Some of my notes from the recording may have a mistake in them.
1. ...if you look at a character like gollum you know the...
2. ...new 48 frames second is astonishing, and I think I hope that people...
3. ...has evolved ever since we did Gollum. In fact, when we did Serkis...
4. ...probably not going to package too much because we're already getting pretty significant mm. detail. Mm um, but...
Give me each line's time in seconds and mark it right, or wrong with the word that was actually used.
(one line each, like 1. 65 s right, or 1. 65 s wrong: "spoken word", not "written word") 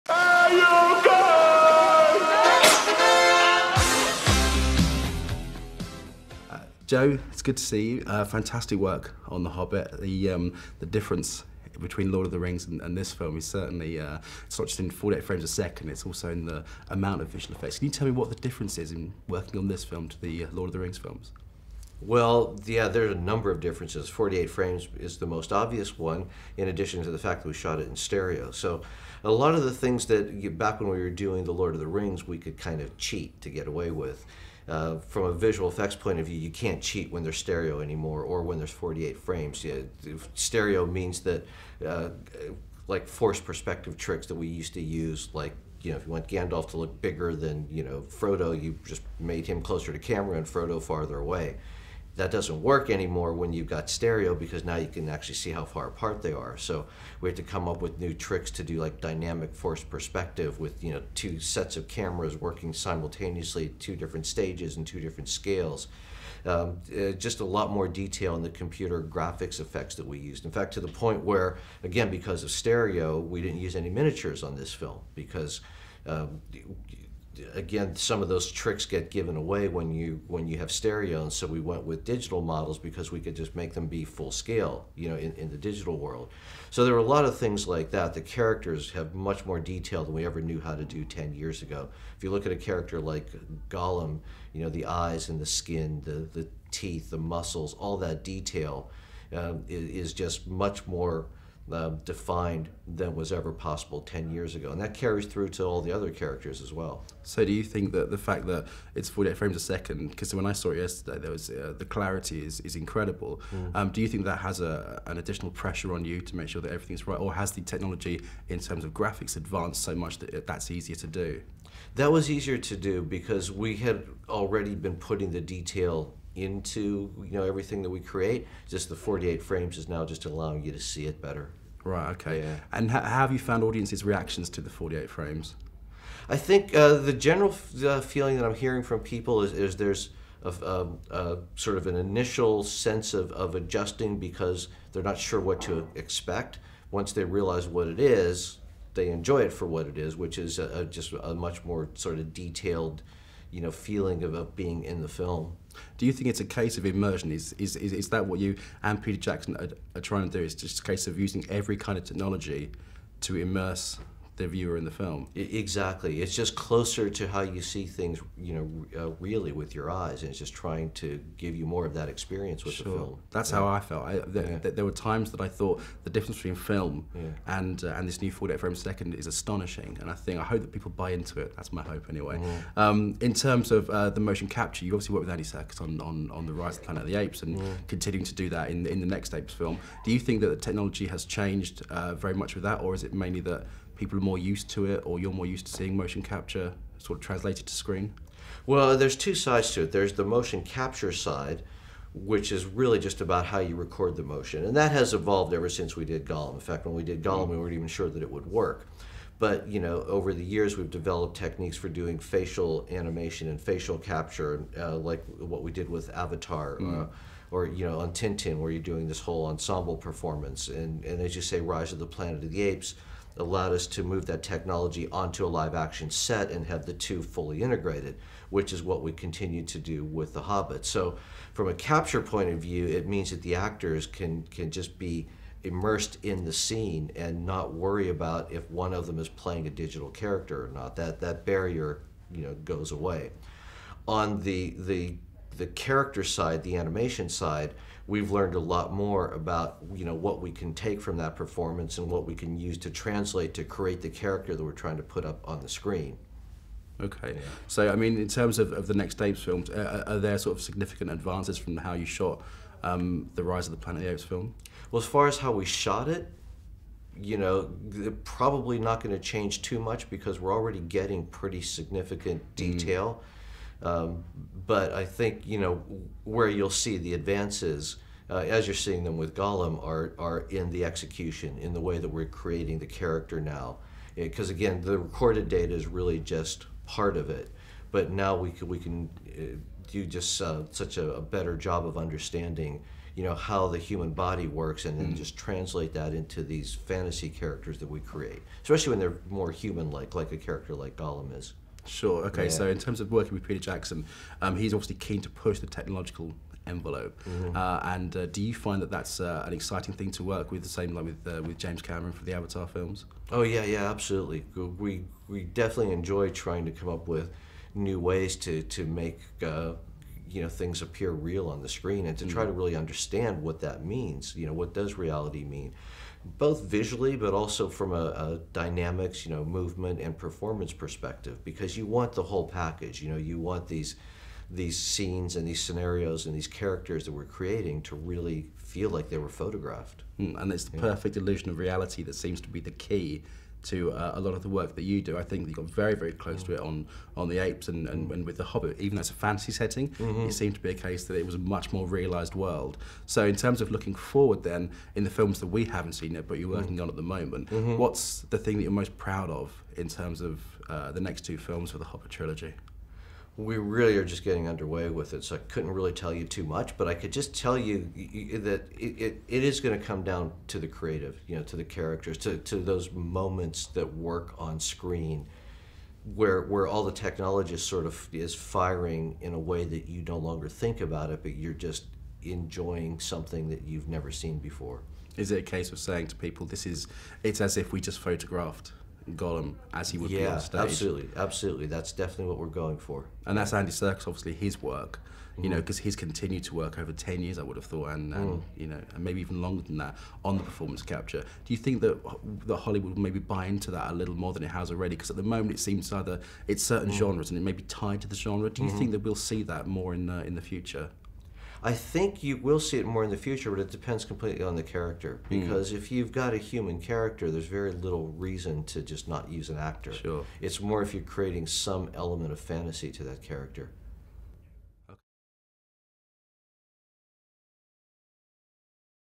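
1. 92 s right
2. 178 s right
3. 204 s wrong: "Gollum", not "Serkis"
4. 268 s wrong: "change", not "package".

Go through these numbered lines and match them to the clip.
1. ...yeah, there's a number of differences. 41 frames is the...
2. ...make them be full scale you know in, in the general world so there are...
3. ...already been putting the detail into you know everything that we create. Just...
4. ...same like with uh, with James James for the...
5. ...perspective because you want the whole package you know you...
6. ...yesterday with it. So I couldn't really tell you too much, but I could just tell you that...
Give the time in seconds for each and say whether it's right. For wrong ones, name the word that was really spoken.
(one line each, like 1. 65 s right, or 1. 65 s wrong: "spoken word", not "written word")
1. 22 s wrong: "48", not "41"
2. 83 s wrong: "digital", not "general"
3. 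124 s right
4. 310 s wrong: "Cameron", not "James"
5. 330 s right
6. 364 s wrong: "underway", not "yesterday".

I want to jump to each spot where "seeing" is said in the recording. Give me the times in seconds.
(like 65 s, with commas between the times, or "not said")
195 s, 278 s.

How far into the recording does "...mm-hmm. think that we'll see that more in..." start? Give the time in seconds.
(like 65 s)
408 s.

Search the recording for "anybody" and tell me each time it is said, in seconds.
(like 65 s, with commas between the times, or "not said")
not said.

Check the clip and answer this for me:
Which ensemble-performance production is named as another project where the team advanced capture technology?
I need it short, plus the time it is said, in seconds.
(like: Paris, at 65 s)
Tintin, at 218 s.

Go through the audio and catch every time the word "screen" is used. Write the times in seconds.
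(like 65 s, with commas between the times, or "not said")
197 s, 255 s, 321 s, 374 s.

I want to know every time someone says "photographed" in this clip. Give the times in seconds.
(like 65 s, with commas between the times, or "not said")
339 s, 387 s.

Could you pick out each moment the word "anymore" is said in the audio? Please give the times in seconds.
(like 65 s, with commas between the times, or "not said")
37 s, 52 s.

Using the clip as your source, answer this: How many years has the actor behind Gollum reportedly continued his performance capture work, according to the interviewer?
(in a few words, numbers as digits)
10 years.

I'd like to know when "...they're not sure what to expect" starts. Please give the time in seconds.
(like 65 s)
144 s.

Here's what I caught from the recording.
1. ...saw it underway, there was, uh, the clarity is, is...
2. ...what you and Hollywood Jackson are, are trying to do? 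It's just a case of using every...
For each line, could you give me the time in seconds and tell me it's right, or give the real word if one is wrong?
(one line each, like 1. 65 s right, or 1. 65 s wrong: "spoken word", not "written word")
1. 110 s wrong: "yesterday", not "underway"
2. 158 s wrong: "Peter", not "Hollywood".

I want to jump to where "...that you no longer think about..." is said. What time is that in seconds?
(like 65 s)
379 s.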